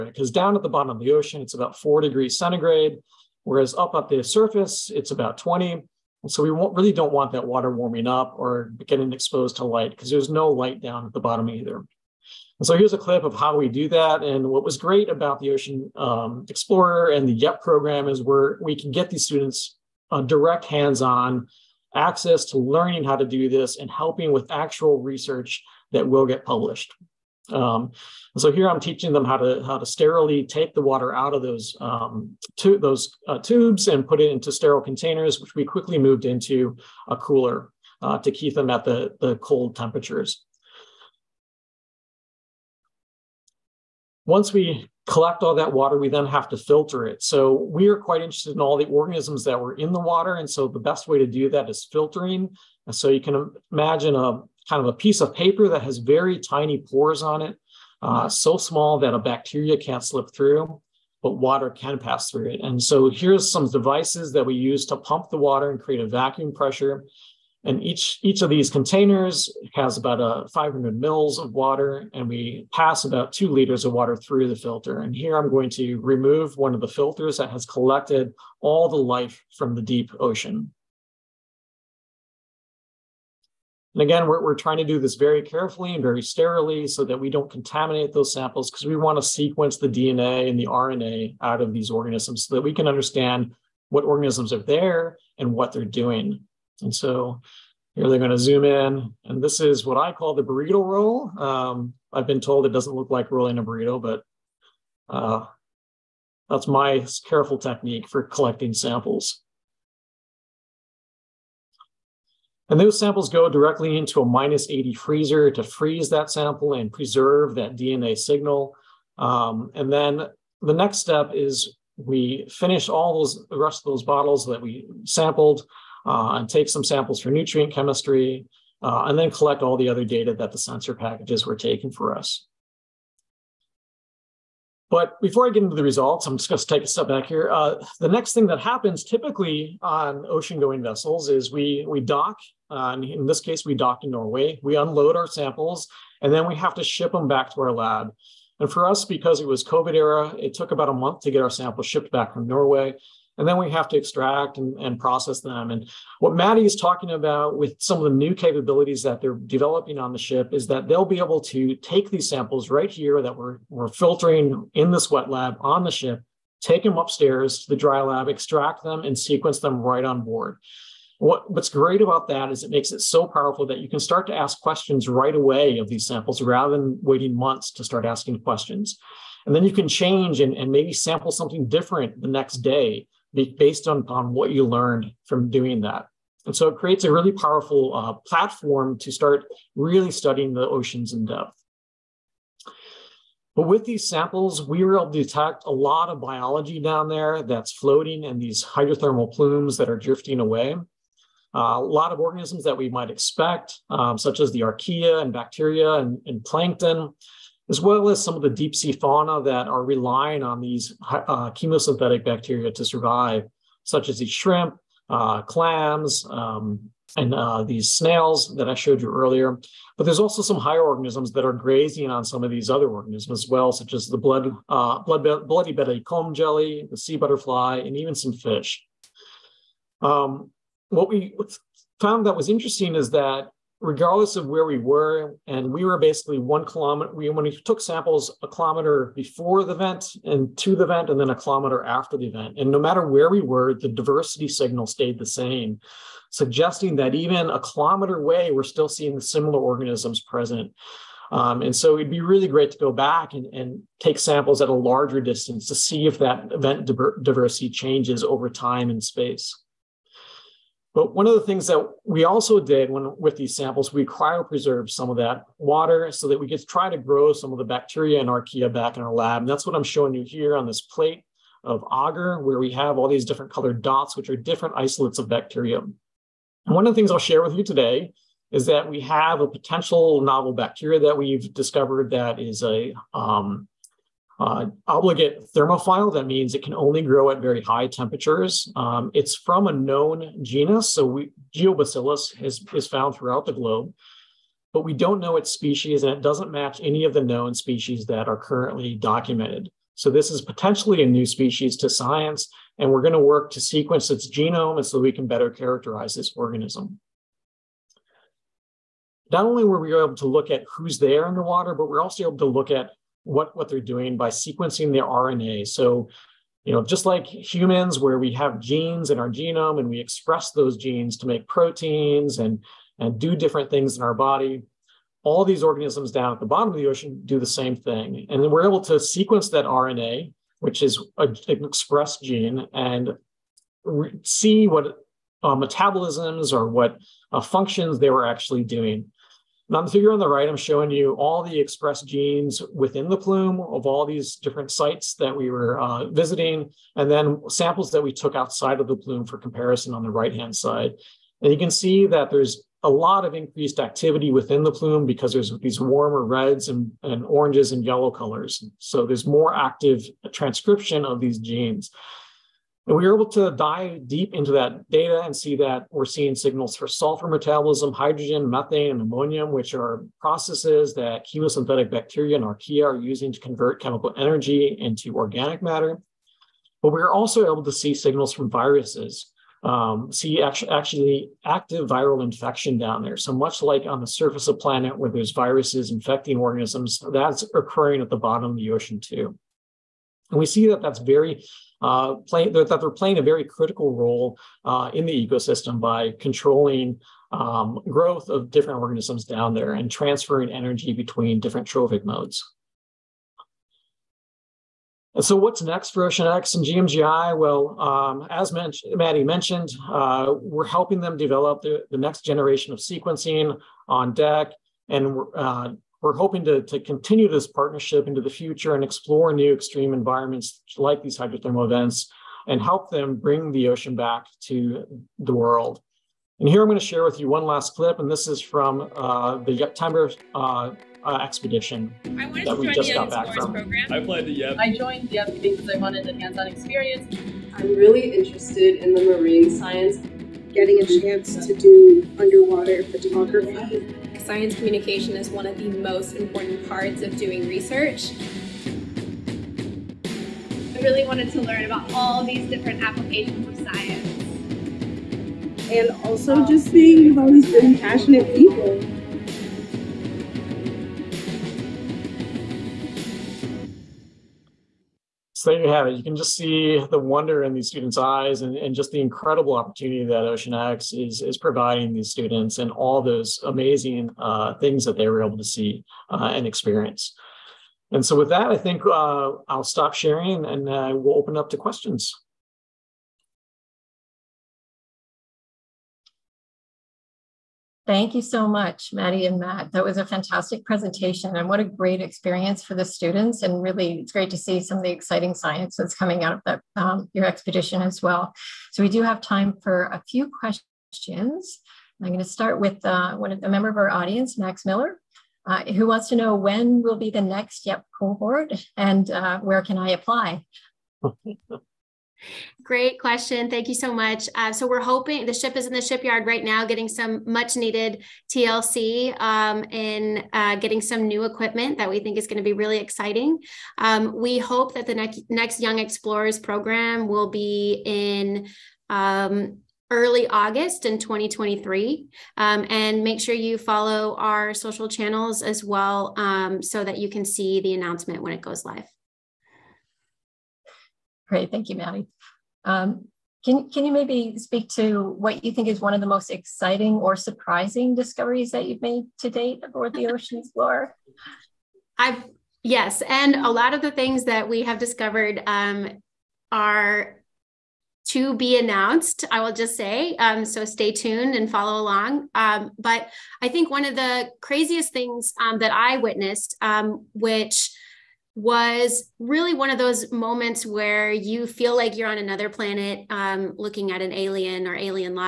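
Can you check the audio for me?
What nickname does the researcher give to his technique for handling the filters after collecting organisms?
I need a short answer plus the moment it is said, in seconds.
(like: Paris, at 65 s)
the burrito roll, at 100 s.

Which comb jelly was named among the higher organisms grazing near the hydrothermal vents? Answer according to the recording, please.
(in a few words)
bloody belly comb jelly.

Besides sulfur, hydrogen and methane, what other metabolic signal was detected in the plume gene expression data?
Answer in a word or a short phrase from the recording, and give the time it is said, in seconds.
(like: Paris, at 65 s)
ammonium, at 369 s.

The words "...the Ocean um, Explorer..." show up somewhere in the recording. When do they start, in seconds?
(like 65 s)
15 s.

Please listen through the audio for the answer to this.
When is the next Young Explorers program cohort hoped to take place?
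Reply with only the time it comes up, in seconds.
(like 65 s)
529 s.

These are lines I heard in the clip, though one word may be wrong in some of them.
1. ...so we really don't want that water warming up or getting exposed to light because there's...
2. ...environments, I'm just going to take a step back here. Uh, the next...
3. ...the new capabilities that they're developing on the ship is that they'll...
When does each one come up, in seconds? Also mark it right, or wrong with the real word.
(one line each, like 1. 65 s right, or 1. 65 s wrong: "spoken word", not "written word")
1. 6 s right
2. 135 s wrong: "results", not "environments"
3. 158 s right.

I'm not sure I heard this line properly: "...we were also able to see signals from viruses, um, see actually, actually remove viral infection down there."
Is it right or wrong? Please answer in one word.
wrong.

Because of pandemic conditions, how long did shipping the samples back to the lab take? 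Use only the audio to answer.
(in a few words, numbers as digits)
about a month.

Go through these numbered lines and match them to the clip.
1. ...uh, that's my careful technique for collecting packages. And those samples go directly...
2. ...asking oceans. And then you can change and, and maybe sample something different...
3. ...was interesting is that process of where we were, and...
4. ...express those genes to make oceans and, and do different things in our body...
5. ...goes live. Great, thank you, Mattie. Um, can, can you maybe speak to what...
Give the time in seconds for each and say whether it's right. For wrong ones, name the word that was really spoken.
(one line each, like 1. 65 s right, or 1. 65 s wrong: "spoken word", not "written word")
1. 105 s wrong: "samples", not "packages"
2. 178 s wrong: "questions", not "oceans"
3. 232 s wrong: "regardless", not "process"
4. 319 s wrong: "proteins", not "oceans"
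5. 538 s right.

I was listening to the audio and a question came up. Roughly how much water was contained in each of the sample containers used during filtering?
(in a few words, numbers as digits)
500 ml.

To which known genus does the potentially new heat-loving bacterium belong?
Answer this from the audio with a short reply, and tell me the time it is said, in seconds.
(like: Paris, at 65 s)
Geobacillus, at 291 s.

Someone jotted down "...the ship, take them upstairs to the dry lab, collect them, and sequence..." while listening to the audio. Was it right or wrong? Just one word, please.
wrong.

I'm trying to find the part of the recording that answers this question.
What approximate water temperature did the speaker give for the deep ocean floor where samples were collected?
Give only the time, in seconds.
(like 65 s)
1 s.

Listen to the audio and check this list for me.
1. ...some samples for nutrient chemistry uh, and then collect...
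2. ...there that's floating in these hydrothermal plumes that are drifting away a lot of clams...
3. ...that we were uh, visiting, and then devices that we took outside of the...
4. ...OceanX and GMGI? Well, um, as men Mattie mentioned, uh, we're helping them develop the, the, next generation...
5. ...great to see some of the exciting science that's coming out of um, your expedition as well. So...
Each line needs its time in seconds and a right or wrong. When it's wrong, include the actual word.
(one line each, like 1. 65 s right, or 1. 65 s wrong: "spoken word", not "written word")
1. 126 s right
2. 197 s wrong: "organisms", not "clams"
3. 345 s wrong: "samples", not "devices"
4. 406 s right
5. 494 s right.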